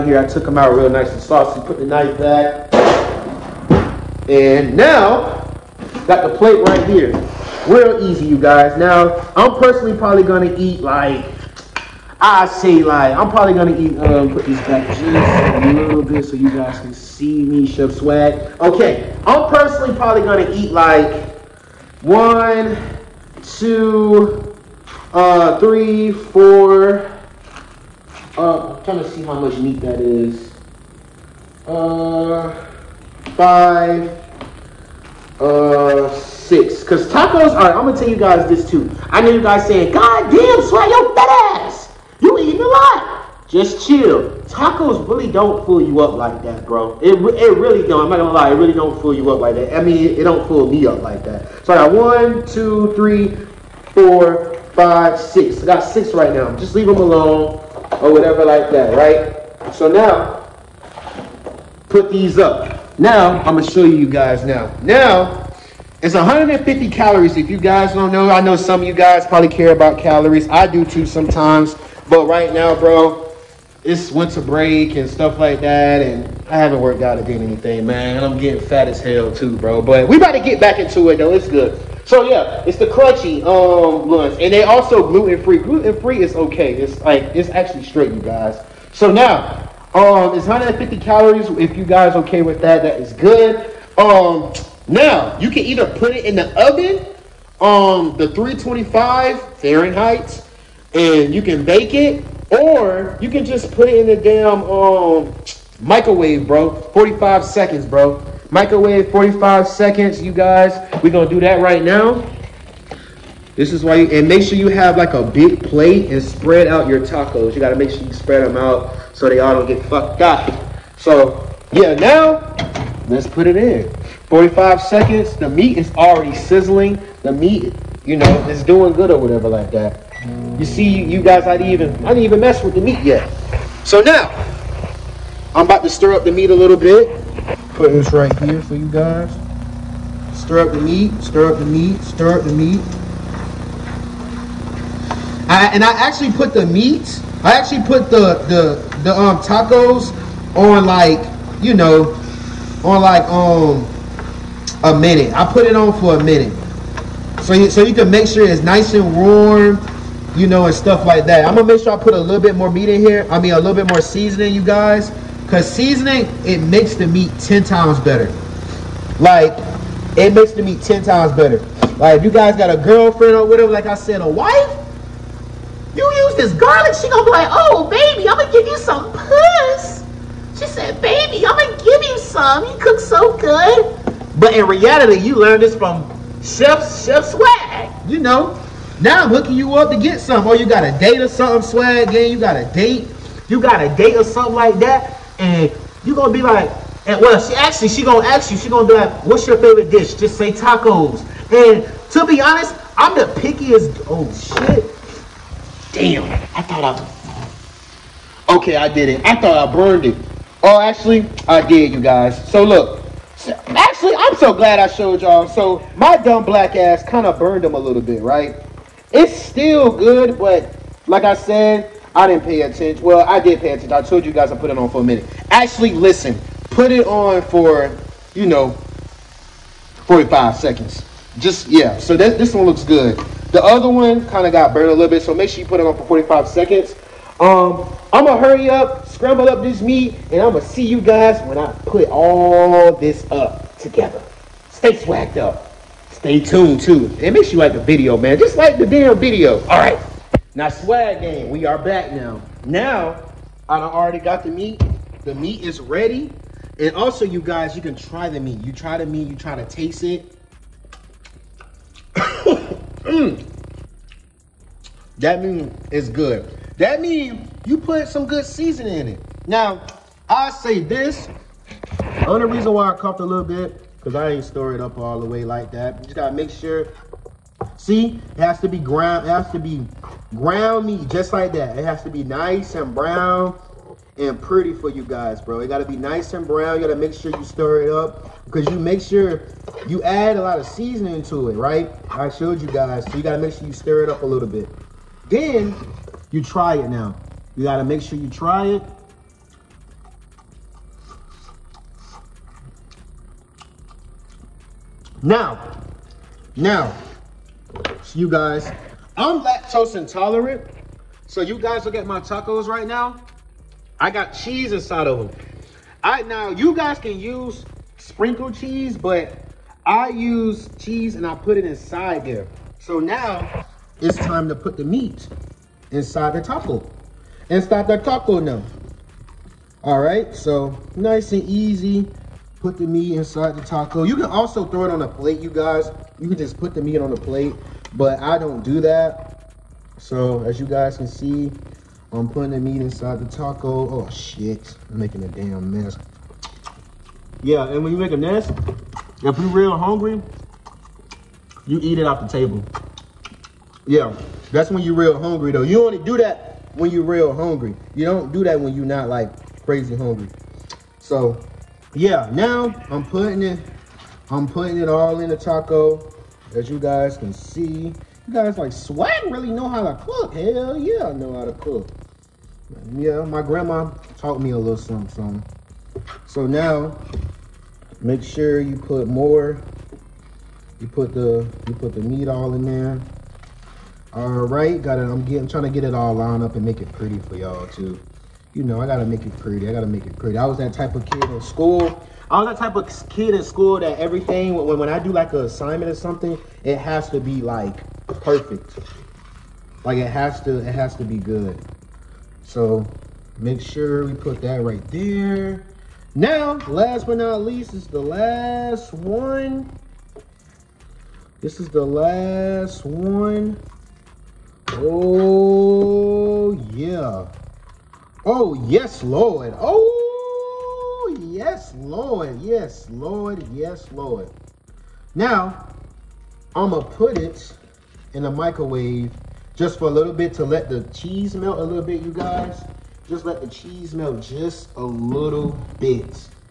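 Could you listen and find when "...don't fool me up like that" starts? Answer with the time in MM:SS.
00:50.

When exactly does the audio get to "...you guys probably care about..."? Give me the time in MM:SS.
01:08.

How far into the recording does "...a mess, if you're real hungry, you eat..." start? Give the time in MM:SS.
05:48.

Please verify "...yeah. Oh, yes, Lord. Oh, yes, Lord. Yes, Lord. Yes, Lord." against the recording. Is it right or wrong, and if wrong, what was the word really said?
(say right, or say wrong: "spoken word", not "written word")
right.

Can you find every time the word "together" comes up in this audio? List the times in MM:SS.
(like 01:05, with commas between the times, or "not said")
04:03.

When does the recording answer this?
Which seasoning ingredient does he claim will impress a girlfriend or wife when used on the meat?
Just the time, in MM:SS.
02:55.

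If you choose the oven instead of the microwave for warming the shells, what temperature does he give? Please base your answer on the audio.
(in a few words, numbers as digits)
325 Fahrenheit.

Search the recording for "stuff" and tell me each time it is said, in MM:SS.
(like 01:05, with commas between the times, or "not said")
01:15, 02:40.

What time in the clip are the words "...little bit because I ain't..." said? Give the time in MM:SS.
04:33.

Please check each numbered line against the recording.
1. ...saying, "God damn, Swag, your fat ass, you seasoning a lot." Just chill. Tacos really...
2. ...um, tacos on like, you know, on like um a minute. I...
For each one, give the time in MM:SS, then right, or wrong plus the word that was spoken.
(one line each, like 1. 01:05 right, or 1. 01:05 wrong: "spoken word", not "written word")
1. 00:39 wrong: "eating", not "seasoning"
2. 02:29 right.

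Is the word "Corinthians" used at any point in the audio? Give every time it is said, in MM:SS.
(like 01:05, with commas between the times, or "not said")
not said.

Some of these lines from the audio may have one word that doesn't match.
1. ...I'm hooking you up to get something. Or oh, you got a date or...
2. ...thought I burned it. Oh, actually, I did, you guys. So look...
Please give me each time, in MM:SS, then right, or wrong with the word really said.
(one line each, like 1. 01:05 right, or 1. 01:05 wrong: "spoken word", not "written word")
1. 03:09 right
2. 03:29 right.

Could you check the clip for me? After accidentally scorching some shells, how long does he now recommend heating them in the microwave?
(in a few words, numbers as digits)
45 seconds.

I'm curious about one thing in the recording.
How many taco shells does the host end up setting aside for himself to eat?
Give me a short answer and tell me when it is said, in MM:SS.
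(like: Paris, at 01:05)
6, at 00:55.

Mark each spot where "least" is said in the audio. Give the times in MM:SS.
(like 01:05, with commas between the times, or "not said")
06:47.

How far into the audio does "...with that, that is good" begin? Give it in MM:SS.
01:32.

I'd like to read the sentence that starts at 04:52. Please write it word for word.
I showed you guys, so you gotta make sure you stir it up a little bit.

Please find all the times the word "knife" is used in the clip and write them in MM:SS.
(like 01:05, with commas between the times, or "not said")
00:01.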